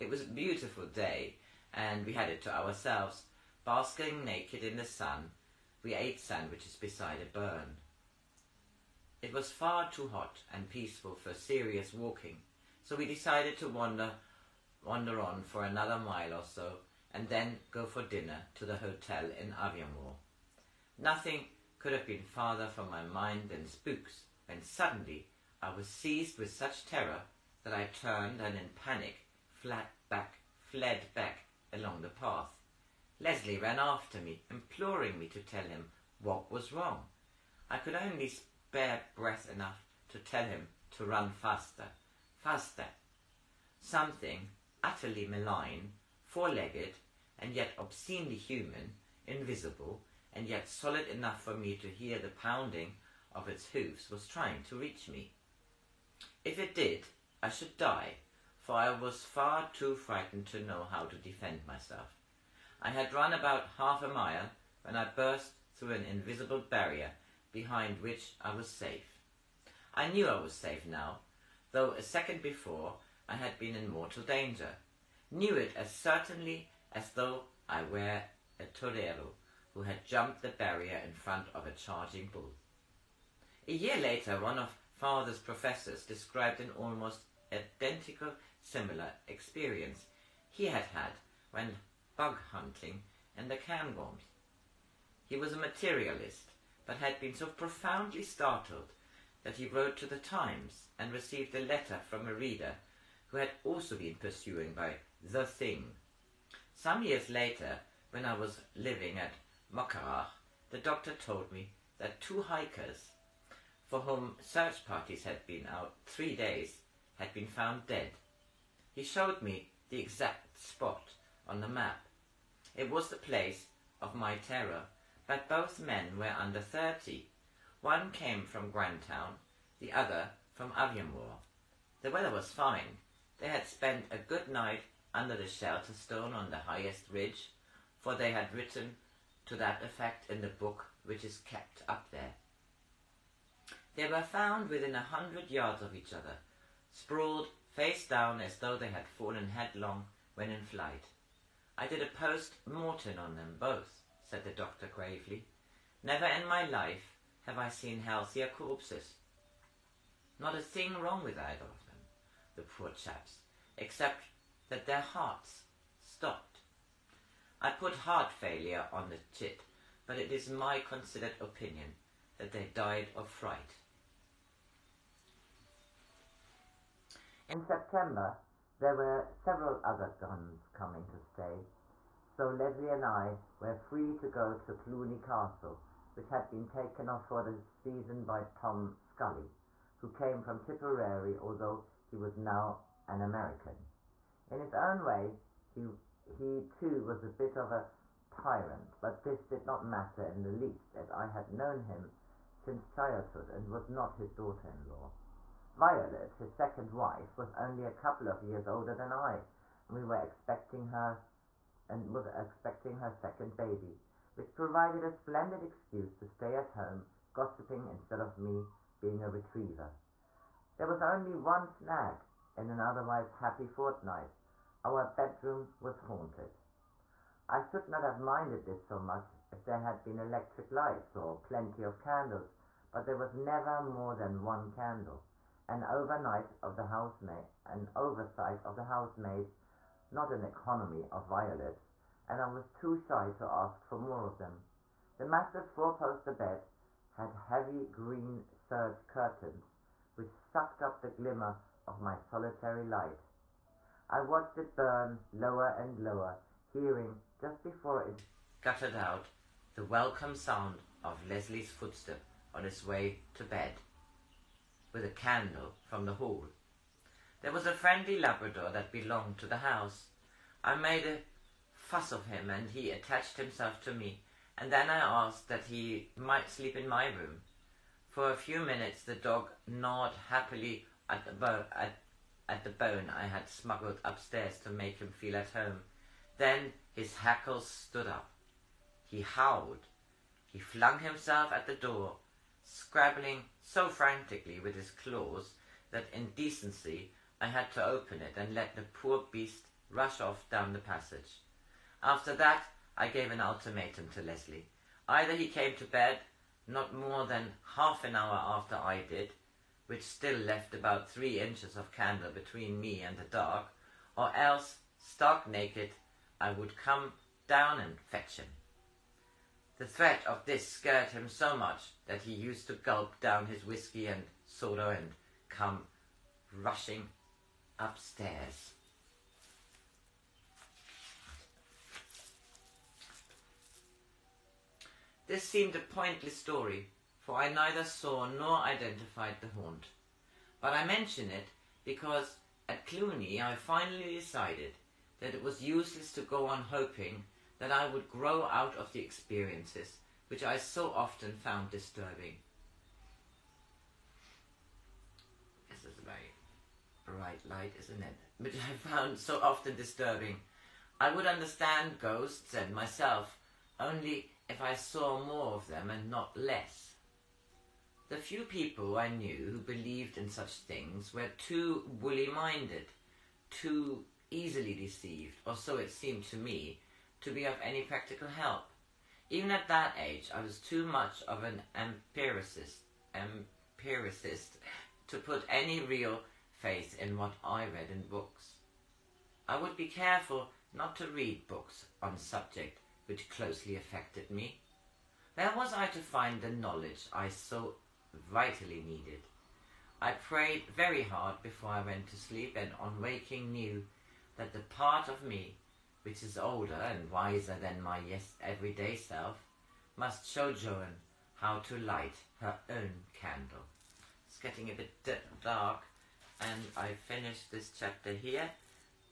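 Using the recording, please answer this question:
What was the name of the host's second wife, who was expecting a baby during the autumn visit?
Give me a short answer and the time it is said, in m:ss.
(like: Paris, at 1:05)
Violet, at 3:25.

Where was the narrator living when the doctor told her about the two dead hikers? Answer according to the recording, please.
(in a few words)
Muckrach.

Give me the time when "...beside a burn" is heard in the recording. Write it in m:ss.
0:06.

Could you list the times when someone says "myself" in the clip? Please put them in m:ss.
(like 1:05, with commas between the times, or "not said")
1:01, 6:02.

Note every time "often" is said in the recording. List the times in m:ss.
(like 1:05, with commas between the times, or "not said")
5:50, 5:59.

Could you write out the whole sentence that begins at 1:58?
He showed me the exact spot on the map.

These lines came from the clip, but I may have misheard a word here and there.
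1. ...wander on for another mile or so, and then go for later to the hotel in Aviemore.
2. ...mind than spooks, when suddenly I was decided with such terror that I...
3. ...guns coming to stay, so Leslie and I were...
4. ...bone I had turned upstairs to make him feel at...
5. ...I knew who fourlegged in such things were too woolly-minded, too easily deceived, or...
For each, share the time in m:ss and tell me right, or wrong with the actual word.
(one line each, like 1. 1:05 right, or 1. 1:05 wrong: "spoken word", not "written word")
1. 0:14 wrong: "dinner", not "later"
2. 0:23 wrong: "seized", not "decided"
3. 3:00 right
4. 4:42 wrong: "smuggled", not "turned"
5. 6:08 wrong: "believed", not "fourlegged".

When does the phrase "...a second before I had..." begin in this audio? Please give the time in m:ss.
1:11.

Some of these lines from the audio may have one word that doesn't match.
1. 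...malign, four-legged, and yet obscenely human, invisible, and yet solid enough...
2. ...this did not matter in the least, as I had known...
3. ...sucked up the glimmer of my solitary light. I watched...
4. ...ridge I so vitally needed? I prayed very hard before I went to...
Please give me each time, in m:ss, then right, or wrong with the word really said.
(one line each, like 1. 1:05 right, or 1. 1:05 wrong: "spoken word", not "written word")
1. 0:45 right
2. 3:19 right
3. 4:10 right
4. 6:36 wrong: "knowledge", not "ridge".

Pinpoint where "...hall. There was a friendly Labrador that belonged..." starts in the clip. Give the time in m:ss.
4:26.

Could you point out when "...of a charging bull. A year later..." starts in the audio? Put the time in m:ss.
1:21.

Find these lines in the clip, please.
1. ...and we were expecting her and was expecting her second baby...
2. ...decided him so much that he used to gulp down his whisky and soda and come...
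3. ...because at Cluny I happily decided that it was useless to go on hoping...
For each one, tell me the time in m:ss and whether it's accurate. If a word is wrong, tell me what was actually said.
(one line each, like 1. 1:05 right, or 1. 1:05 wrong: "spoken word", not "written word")
1. 3:29 right
2. 5:20 wrong: "scared", not "decided"
3. 5:41 wrong: "finally", not "happily".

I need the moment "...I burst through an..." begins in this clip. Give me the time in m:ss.
1:04.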